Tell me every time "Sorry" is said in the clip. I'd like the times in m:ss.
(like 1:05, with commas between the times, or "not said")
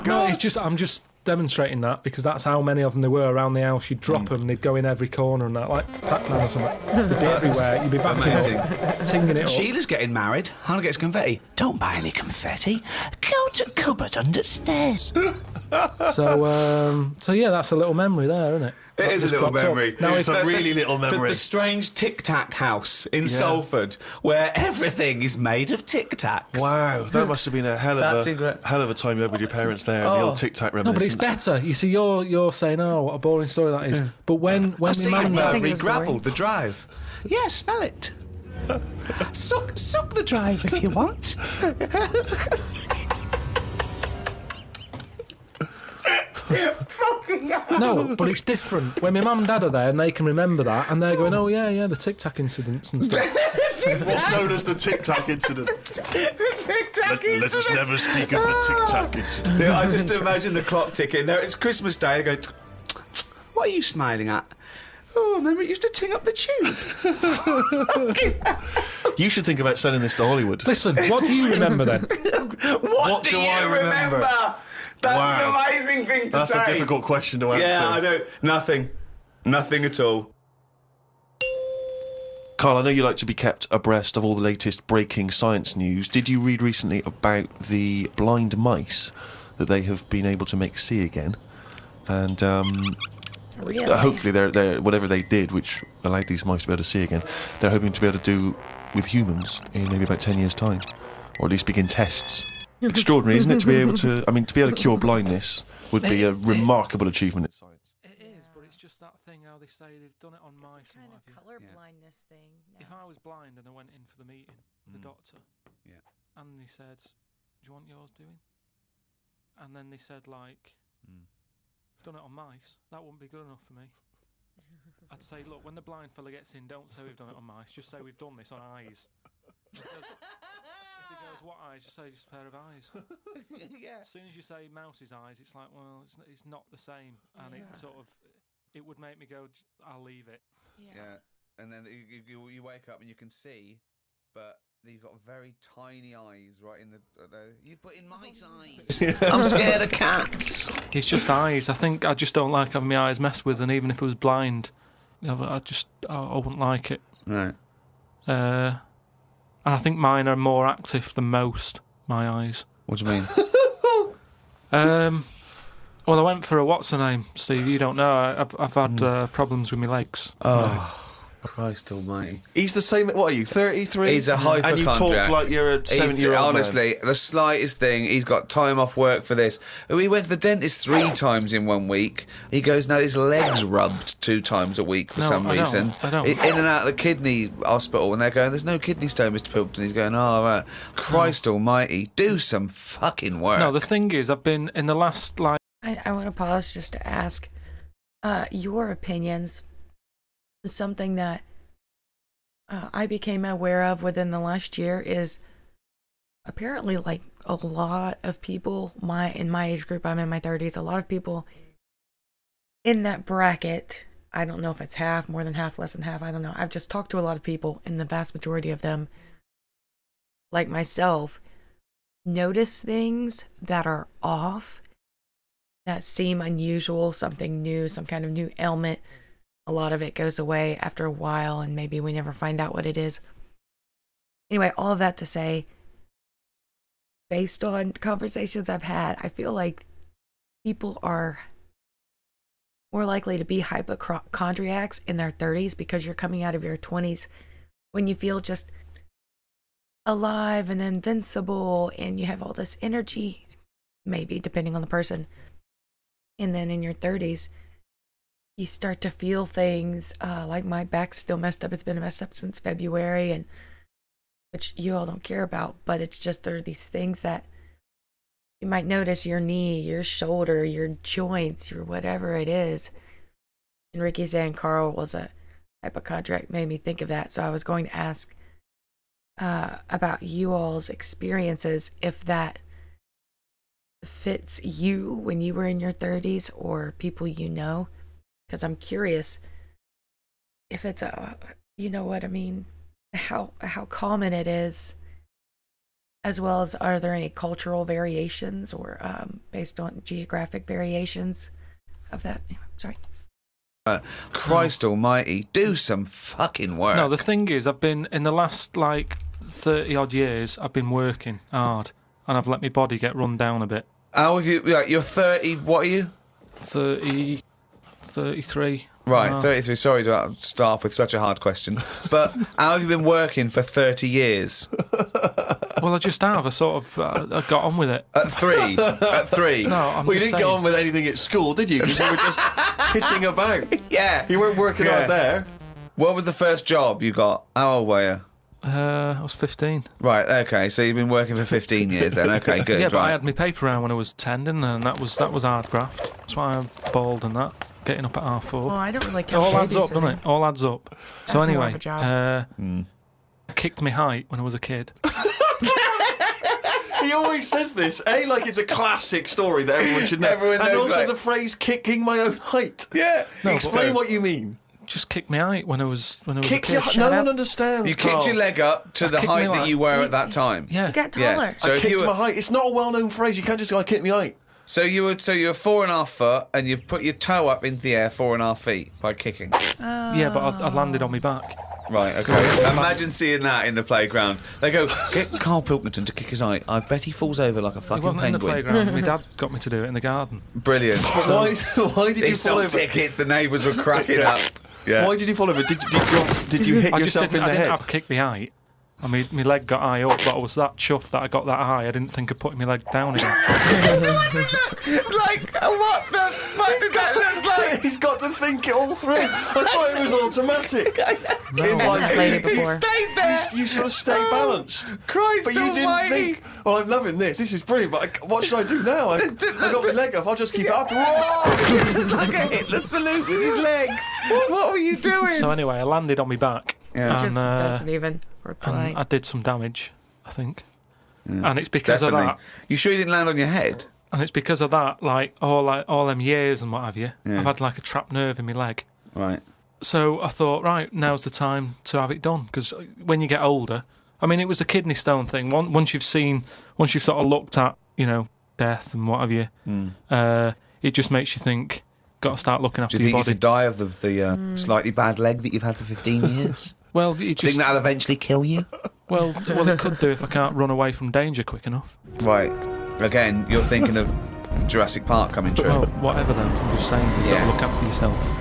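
5:02, 5:19.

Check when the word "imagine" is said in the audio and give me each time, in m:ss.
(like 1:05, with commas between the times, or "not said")
1:00, 6:22.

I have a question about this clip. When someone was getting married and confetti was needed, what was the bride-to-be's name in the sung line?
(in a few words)
Sheila.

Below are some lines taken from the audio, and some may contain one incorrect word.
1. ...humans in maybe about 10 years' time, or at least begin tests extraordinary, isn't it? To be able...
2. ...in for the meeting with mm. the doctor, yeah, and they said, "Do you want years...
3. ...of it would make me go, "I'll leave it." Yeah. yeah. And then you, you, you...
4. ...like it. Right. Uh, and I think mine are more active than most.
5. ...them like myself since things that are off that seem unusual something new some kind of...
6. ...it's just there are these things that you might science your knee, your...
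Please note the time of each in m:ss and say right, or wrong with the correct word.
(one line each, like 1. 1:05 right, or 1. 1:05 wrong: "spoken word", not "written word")
1. 1:39 right
2. 1:53 wrong: "yours", not "years"
3. 2:17 right
4. 2:36 right
5. 3:38 wrong: "notice", not "since"
6. 4:26 wrong: "notice", not "science".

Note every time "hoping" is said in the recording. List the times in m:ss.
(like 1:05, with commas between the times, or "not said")
1:37.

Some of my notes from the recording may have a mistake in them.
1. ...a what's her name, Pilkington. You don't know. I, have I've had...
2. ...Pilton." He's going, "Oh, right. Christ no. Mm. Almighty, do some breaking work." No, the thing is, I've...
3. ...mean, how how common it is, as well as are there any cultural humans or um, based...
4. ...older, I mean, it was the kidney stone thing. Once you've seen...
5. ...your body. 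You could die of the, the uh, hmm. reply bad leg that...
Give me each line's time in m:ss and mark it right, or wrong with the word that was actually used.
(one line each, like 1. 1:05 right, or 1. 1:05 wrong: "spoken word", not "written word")
1. 2:46 wrong: "Steve", not "Pilkington"
2. 3:09 wrong: "fucking", not "breaking"
3. 4:52 wrong: "variations", not "humans"
4. 7:23 right
5. 7:33 wrong: "slightly", not "reply".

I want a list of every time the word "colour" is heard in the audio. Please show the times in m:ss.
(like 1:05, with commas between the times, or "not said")
1:51.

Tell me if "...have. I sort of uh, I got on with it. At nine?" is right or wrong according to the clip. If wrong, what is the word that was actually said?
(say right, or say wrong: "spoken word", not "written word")
wrong: "three", not "nine".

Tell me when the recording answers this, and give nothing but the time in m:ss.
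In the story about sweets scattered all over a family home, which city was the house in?
0:23.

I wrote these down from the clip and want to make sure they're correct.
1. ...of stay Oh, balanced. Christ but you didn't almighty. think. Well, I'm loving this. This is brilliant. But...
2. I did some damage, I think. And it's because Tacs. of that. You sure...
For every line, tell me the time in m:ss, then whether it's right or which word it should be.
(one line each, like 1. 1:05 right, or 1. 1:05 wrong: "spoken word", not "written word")
1. 6:53 right
2. 7:08 wrong: "Definitely", not "Tacs".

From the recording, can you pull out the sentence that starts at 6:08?
kicked your leg up to I the height that you were at that time.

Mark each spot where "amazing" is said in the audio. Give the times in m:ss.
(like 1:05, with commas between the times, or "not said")
0:08, 1:15.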